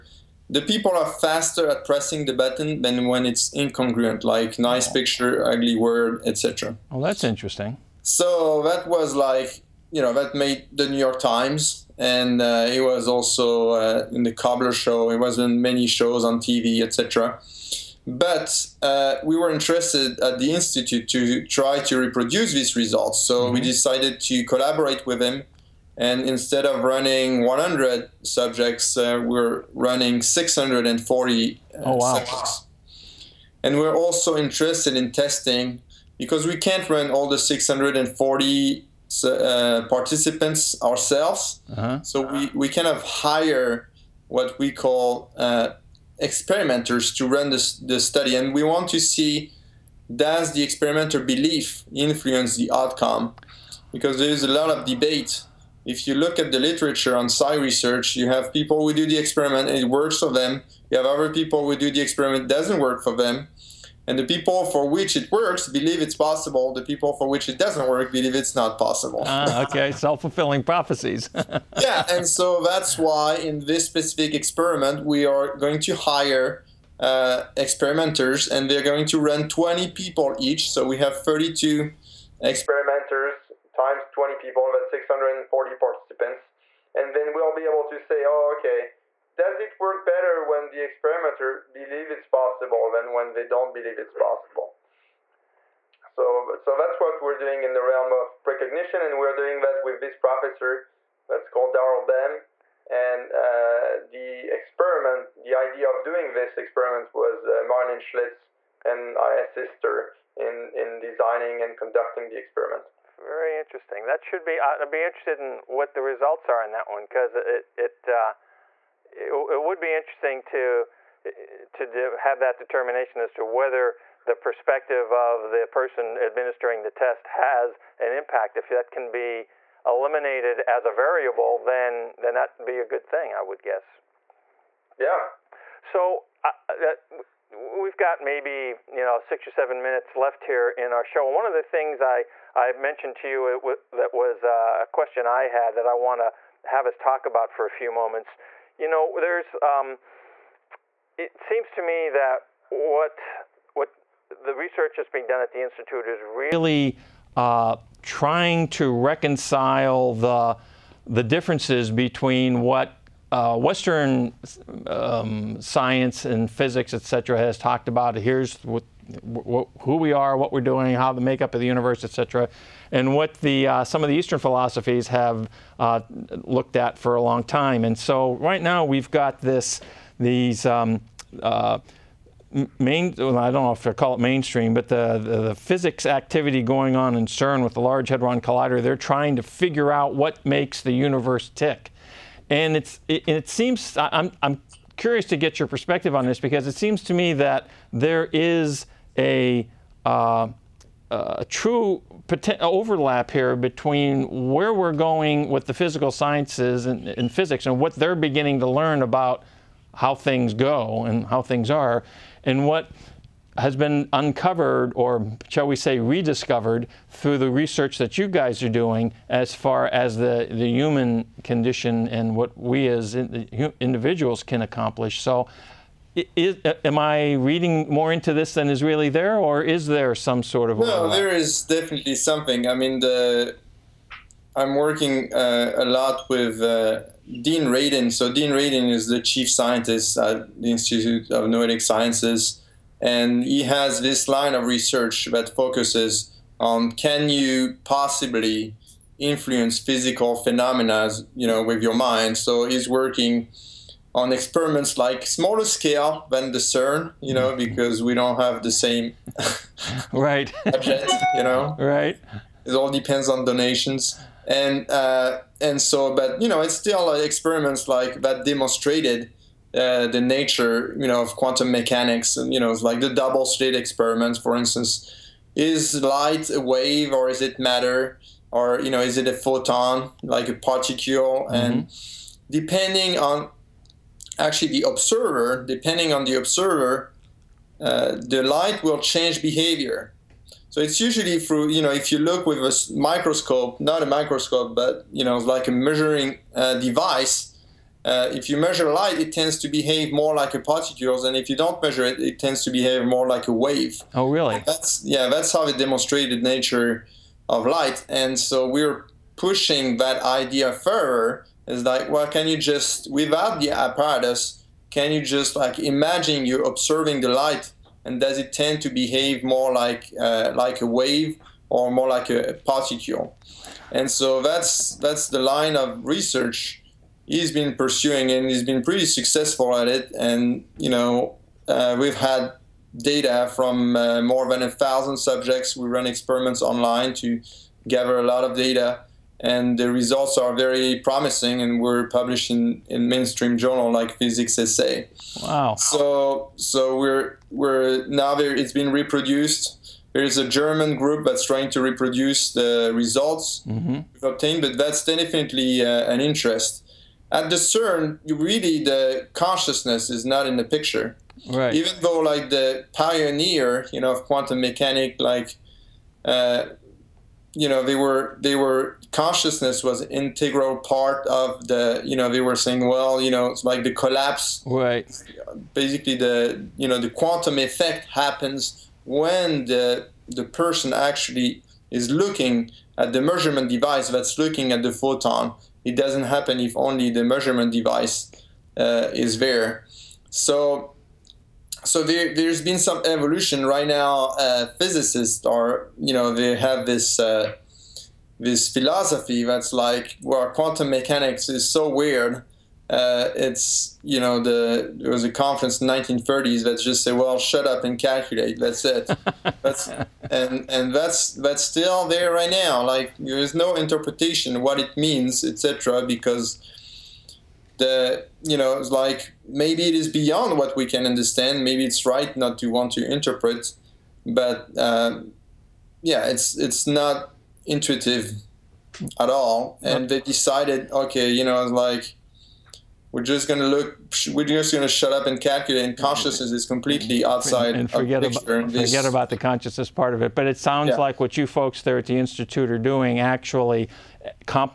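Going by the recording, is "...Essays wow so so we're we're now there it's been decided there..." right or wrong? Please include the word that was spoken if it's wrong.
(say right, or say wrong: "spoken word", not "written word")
wrong: "reproduced", not "decided".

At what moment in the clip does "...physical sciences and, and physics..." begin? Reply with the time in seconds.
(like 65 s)
205 s.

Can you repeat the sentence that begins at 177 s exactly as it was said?
And so right now we've got this these.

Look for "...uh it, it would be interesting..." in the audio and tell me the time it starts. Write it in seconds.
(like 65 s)
118 s.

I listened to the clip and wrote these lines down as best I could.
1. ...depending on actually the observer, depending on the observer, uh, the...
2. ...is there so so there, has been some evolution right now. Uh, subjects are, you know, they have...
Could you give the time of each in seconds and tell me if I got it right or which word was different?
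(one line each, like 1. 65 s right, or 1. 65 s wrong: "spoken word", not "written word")
1. 282 s right
2. 389 s wrong: "physicists", not "subjects".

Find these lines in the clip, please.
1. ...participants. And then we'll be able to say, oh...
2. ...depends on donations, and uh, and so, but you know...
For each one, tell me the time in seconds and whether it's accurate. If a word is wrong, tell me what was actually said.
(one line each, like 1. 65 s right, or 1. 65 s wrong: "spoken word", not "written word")
1. 85 s right
2. 262 s right.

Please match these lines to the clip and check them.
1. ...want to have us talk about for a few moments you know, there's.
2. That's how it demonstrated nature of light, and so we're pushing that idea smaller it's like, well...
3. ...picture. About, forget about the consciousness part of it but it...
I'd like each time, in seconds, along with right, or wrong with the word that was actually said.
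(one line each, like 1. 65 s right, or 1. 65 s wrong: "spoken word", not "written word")
1. 145 s right
2. 305 s wrong: "further", not "smaller"
3. 438 s right.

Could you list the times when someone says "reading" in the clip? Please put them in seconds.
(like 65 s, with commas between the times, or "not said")
227 s.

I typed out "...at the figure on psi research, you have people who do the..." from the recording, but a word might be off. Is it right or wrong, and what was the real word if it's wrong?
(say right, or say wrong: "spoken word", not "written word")
wrong: "literature", not "figure".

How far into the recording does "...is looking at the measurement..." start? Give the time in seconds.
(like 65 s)
381 s.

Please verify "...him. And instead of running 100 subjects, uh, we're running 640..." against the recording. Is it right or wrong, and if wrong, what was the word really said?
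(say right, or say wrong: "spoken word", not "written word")
right.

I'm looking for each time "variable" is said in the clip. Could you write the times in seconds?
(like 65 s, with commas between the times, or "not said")
130 s.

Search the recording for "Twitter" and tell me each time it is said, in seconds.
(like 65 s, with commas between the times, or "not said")
not said.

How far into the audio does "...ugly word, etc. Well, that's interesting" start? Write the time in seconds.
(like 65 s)
5 s.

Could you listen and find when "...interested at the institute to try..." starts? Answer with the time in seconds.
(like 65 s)
19 s.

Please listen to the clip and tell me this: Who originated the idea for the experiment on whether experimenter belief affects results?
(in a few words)
Marilyn Schlitz.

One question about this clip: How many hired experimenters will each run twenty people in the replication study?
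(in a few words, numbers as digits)
32.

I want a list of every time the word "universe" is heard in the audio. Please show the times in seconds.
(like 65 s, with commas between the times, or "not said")
171 s, 190 s.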